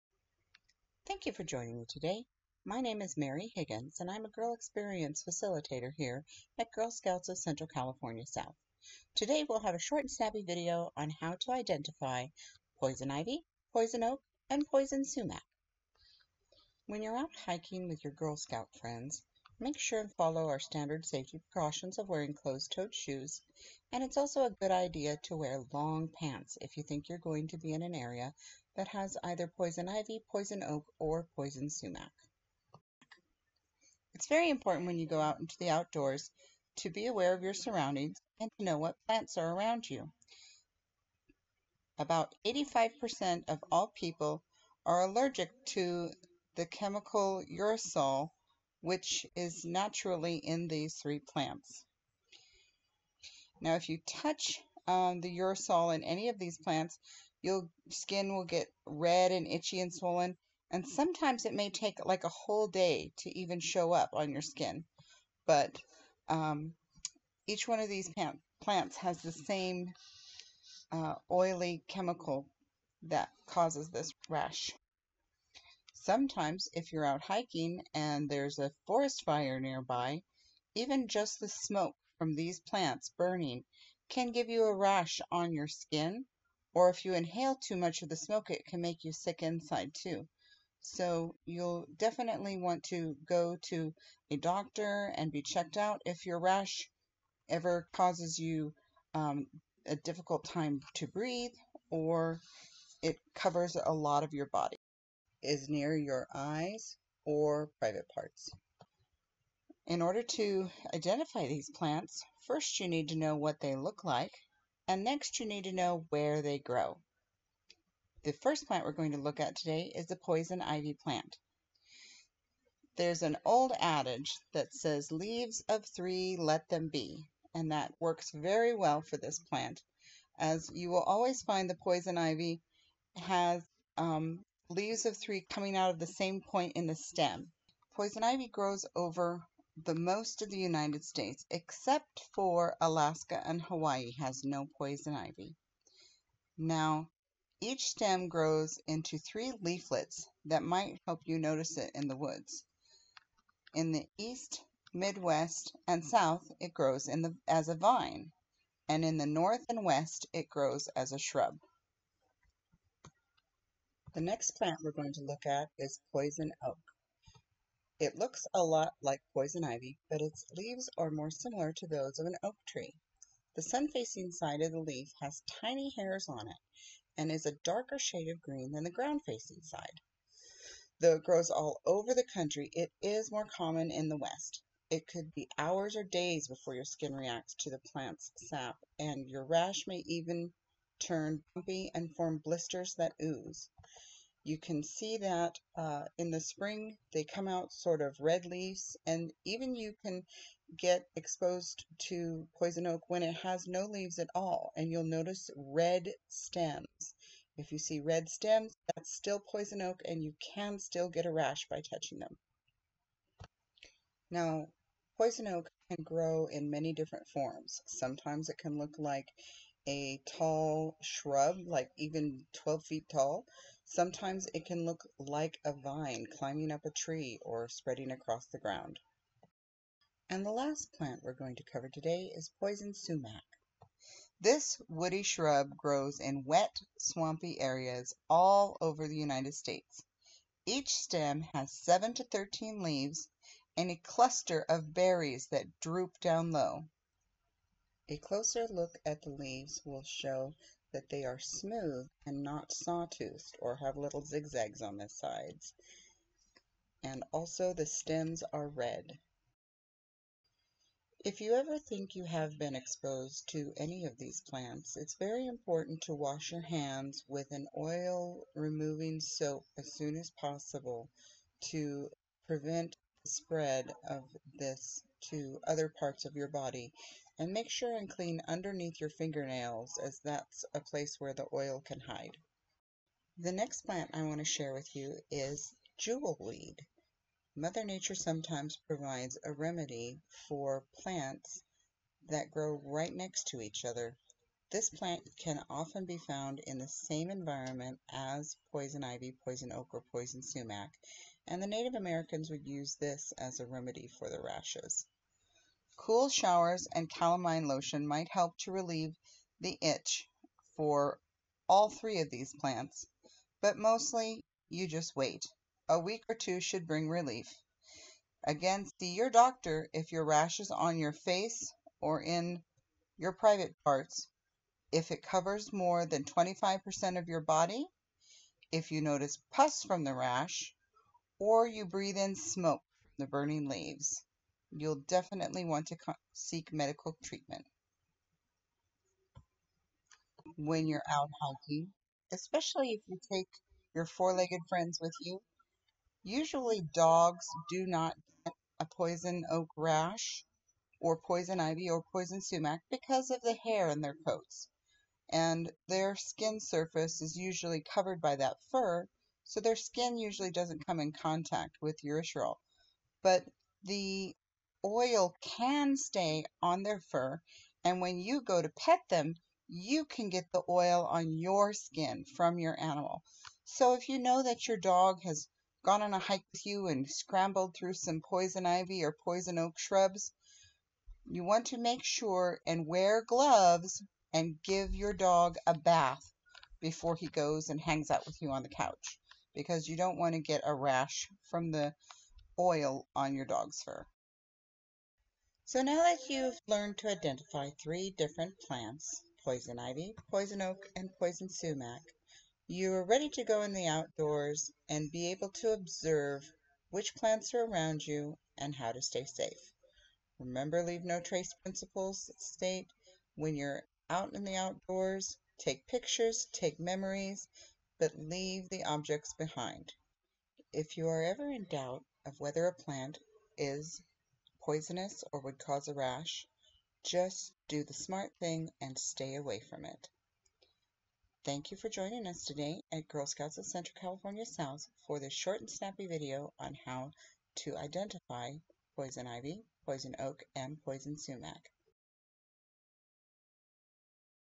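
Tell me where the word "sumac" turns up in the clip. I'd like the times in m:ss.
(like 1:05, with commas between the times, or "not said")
0:15, 0:31, 3:52, 5:00, 5:52, 6:41, 7:21.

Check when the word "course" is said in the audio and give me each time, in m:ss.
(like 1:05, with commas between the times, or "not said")
not said.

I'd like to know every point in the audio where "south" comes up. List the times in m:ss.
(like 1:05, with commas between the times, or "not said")
0:08, 2:36, 7:14.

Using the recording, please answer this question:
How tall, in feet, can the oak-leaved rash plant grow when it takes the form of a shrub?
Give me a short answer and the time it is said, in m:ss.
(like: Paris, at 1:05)
12 feet, at 3:42.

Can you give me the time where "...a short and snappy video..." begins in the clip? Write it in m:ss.
0:09.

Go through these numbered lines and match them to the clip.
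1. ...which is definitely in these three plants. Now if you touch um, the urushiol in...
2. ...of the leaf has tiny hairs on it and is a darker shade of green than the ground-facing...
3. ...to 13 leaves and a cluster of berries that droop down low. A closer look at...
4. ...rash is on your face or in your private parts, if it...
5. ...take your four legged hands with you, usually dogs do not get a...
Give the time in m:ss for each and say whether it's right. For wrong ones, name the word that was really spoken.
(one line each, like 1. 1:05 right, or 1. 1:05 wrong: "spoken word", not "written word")
1. 0:48 wrong: "naturally", not "definitely"
2. 2:54 right
3. 4:02 right
4. 5:20 right
5. 5:43 wrong: "friends", not "hands".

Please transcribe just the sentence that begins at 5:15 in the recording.
A week or two should bring relief.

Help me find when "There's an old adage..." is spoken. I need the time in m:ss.
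2:02.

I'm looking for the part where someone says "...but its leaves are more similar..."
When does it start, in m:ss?
2:50.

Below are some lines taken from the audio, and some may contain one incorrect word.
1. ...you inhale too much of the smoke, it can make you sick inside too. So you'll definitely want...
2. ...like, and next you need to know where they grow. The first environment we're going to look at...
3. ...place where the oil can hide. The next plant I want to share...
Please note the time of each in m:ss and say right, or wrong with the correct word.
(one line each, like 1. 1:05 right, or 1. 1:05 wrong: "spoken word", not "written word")
1. 1:27 right
2. 1:54 wrong: "plant", not "environment"
3. 4:40 right.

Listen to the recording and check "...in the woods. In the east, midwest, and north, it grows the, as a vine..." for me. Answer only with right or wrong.
wrong.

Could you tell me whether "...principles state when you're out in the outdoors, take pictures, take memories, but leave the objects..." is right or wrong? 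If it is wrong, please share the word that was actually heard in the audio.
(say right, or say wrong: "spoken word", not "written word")
right.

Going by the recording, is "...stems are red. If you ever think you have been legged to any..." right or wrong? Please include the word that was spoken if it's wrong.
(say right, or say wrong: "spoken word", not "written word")
wrong: "exposed", not "legged".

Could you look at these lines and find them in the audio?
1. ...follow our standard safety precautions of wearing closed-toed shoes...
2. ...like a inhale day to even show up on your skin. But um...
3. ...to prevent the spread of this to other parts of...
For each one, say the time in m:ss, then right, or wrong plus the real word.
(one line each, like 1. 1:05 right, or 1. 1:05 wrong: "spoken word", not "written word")
1. 0:20 right
2. 1:02 wrong: "whole", not "inhale"
3. 4:31 right.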